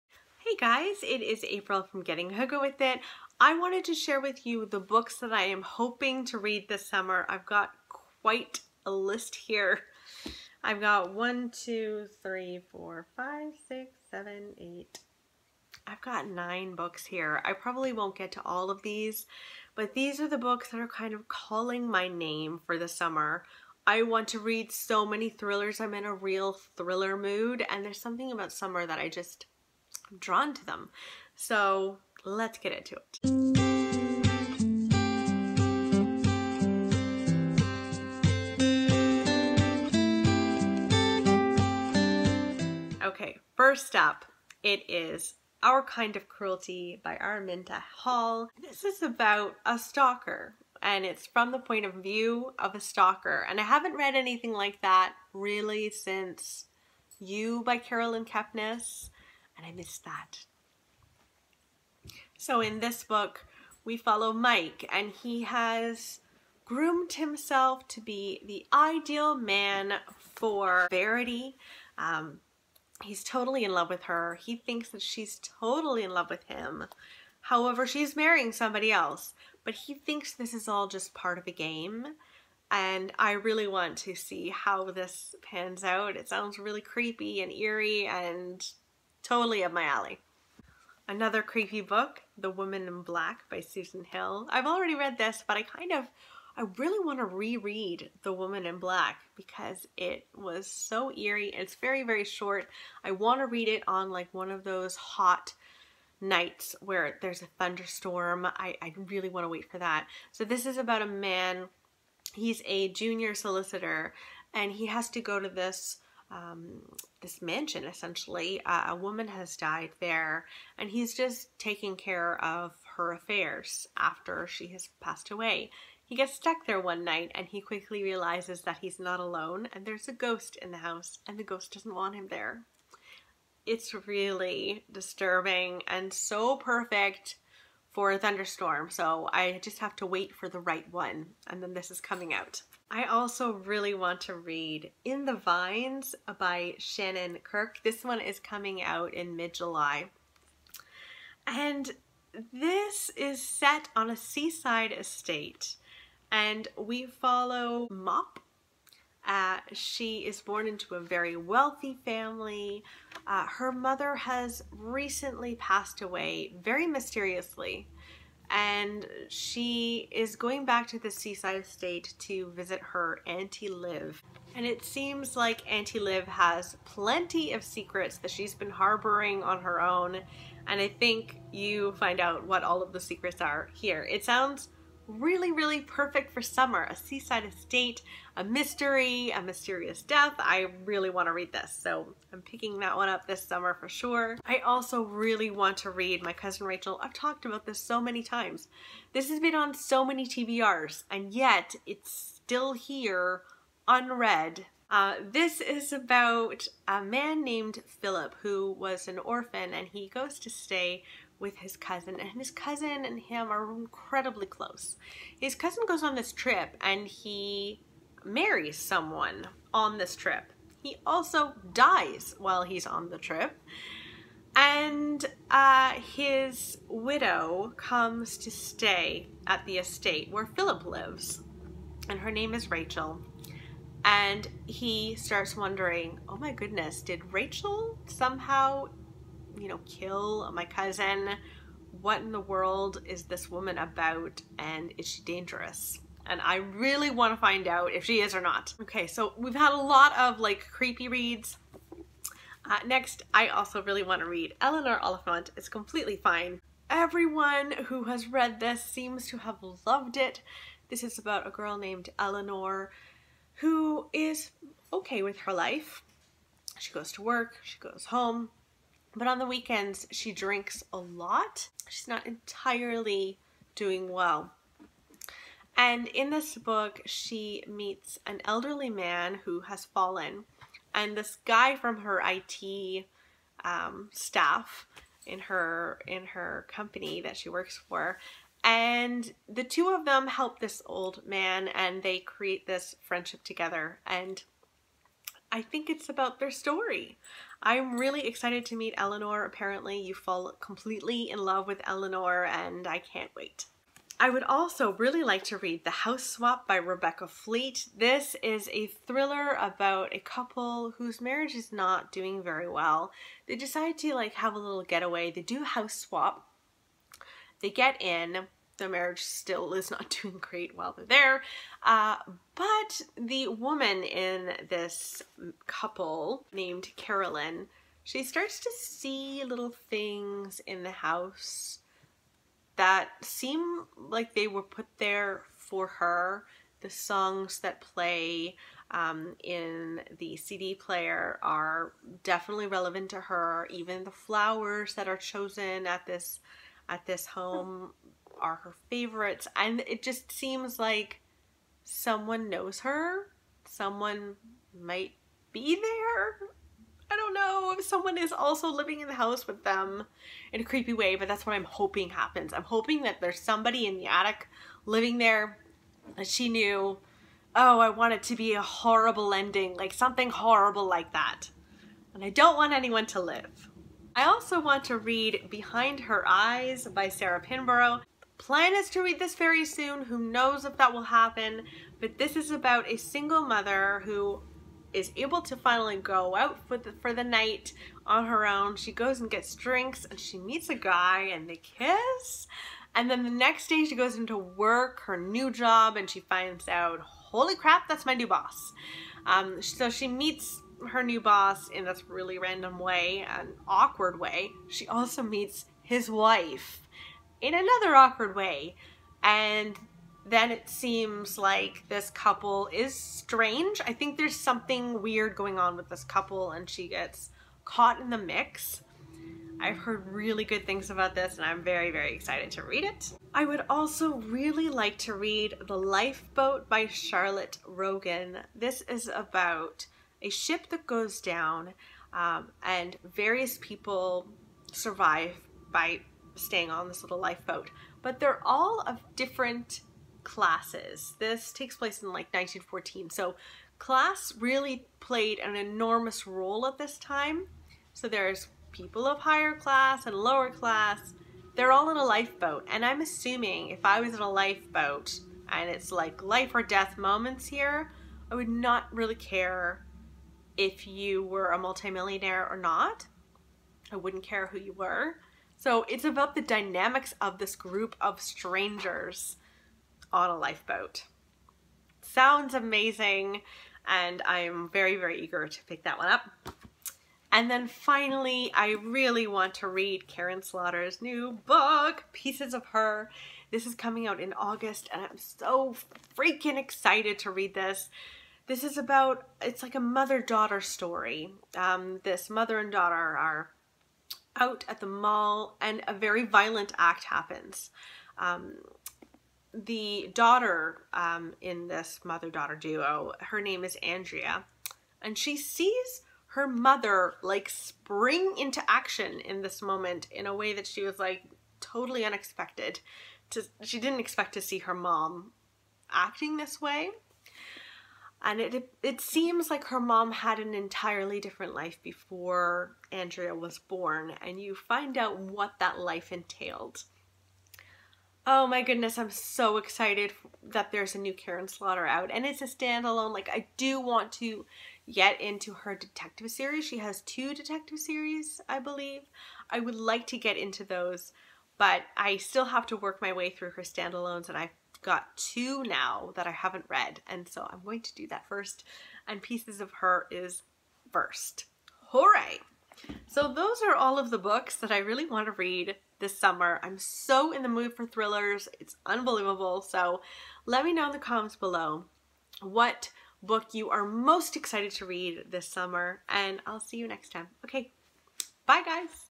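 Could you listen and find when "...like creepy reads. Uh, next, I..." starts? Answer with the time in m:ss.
4:10.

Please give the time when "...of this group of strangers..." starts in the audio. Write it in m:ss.
7:47.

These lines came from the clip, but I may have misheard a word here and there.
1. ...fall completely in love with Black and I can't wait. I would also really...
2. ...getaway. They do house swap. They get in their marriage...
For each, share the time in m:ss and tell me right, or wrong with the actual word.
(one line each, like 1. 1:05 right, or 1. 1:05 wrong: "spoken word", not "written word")
1. 5:00 wrong: "Eleanor", not "Black"
2. 5:14 right.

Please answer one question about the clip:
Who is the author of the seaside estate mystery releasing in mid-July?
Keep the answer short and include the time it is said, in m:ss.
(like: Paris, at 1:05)
Shannon Kirk, at 2:26.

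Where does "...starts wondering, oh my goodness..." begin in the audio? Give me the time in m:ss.
3:55.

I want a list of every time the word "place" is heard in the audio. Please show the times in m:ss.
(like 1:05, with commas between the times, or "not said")
7:21.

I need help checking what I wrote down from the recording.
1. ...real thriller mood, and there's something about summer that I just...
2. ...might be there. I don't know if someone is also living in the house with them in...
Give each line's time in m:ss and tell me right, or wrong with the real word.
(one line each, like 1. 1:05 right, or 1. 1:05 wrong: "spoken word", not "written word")
1. 0:26 right
2. 5:54 right.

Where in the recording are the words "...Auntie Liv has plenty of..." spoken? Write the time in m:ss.
2:55.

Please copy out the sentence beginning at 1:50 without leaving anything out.
So this is about a man, he's a junior solicitor and he has to go to this um, this mansion essentially.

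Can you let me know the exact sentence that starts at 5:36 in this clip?
The songs that play um, in the CD player are definitely relevant to her.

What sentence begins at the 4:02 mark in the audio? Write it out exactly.
What in the world is this woman about and is she dangerous?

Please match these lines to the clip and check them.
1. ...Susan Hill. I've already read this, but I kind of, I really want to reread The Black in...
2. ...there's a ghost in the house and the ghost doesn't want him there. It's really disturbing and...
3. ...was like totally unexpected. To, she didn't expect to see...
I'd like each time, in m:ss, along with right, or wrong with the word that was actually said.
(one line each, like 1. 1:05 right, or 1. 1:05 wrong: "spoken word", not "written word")
1. 1:33 wrong: "Woman", not "Black"
2. 2:09 right
3. 8:30 right.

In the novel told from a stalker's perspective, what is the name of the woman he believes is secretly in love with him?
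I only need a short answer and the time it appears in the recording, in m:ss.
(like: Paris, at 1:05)
Verity, at 1:10.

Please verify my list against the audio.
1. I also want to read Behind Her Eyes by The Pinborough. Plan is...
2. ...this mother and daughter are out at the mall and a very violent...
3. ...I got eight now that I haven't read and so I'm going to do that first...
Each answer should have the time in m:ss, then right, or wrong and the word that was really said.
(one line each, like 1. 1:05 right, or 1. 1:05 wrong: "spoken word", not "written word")
1. 6:14 wrong: "Sarah", not "The"
2. 8:12 right
3. 9:04 wrong: "two", not "eight".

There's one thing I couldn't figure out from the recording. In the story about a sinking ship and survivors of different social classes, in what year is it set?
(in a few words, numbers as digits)
1914.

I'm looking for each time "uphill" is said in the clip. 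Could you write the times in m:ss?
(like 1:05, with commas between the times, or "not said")
not said.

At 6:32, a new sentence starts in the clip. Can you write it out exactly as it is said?
And then the next day she goes into work, her new job, and she finds out, holy crap, that's my new boss.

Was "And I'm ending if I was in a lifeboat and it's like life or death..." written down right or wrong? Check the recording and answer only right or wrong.
wrong.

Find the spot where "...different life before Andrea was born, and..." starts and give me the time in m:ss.
8:41.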